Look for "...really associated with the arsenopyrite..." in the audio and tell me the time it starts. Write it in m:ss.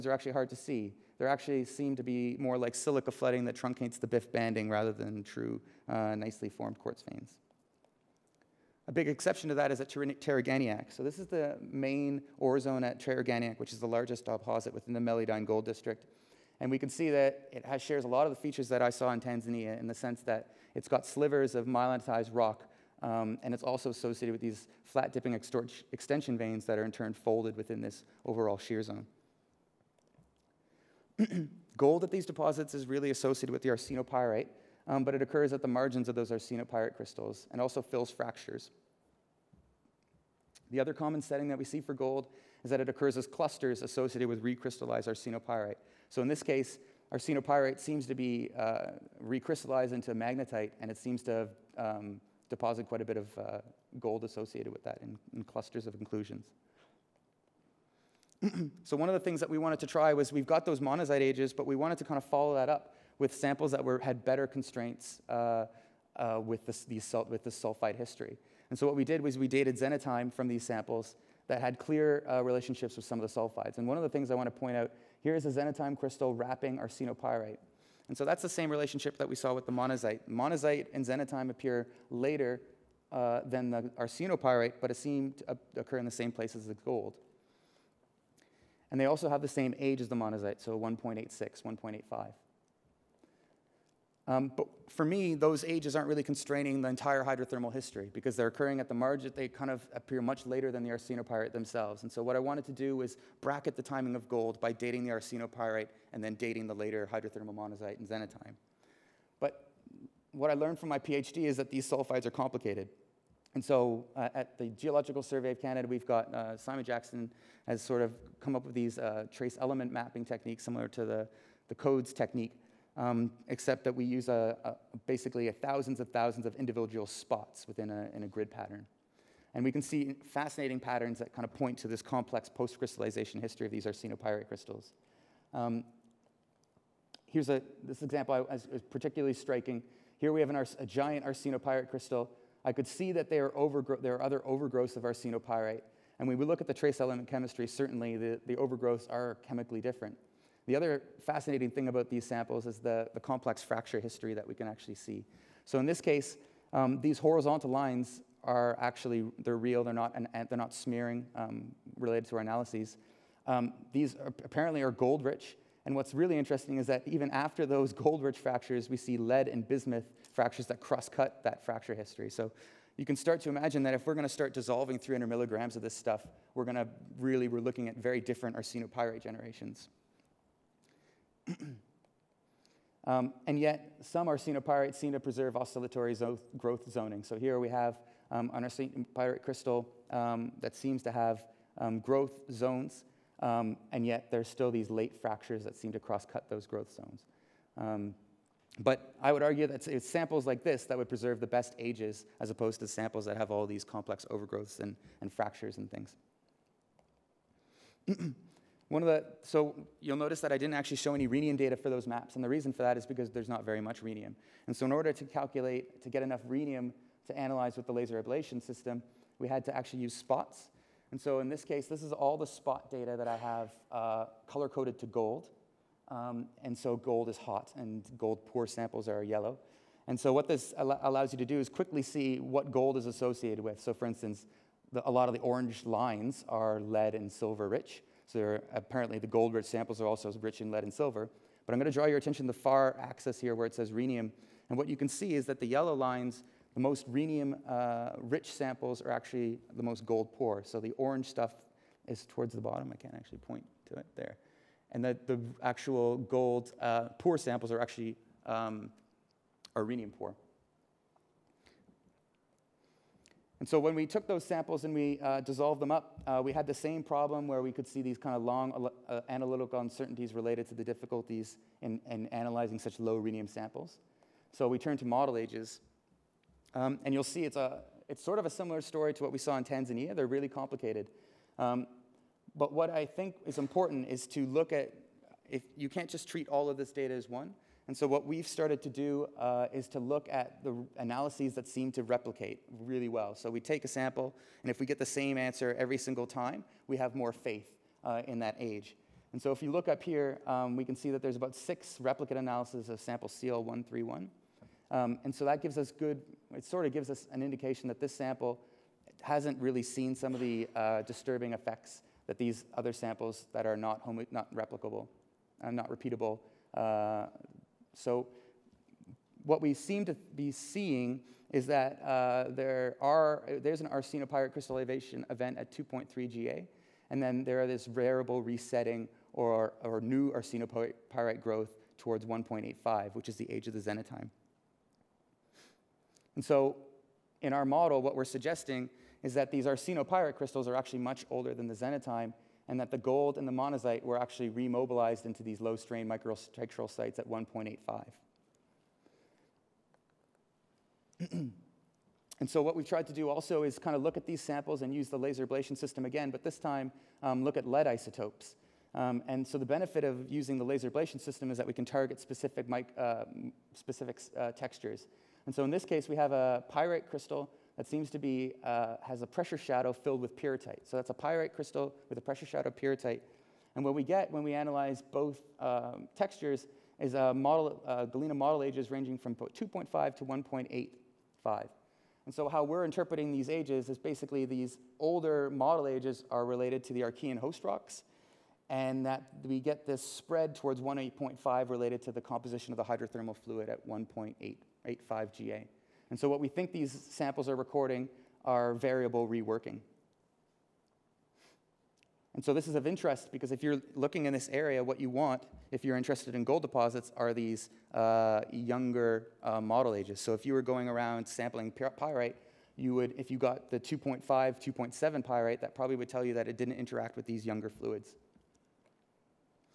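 0:32.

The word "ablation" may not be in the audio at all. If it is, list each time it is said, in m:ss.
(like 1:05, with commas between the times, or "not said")
3:38, 5:55, 6:00.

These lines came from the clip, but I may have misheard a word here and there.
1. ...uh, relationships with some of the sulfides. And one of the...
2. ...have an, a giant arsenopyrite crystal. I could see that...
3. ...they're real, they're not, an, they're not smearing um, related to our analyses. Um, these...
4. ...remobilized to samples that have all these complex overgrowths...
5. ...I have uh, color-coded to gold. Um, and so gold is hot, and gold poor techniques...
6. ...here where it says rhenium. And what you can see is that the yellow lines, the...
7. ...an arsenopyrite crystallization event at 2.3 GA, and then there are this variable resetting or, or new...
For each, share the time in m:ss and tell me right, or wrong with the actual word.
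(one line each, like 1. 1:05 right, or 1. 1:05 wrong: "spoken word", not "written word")
1. 1:12 right
2. 2:20 right
3. 2:39 right
4. 3:22 wrong: "opposed", not "remobilized"
5. 3:43 wrong: "samples", not "techniques"
6. 4:03 right
7. 5:23 right.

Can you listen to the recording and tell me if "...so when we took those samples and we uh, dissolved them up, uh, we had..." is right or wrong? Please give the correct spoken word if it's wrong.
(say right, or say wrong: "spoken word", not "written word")
right.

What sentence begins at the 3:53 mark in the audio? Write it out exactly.
So for instance, the, a lot of the orange lines are lead and silver rich.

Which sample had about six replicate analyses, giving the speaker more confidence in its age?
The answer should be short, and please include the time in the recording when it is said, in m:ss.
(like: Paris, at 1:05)
CL131, at 5:03.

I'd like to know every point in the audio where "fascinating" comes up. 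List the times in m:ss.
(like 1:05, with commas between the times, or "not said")
2:10, 2:31.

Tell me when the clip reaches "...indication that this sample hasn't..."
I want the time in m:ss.
5:07.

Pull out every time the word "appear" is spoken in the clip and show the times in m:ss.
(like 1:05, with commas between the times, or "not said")
1:21, 1:39.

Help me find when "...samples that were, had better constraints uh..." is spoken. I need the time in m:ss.
1:03.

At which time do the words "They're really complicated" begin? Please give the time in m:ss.
4:40.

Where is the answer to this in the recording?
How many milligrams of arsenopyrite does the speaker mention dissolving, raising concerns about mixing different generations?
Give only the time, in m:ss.
2:54.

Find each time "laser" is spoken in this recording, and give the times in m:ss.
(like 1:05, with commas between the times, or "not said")
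3:37, 5:55, 6:00.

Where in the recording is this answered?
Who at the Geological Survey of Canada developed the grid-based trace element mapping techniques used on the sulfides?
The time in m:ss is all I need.
1:56.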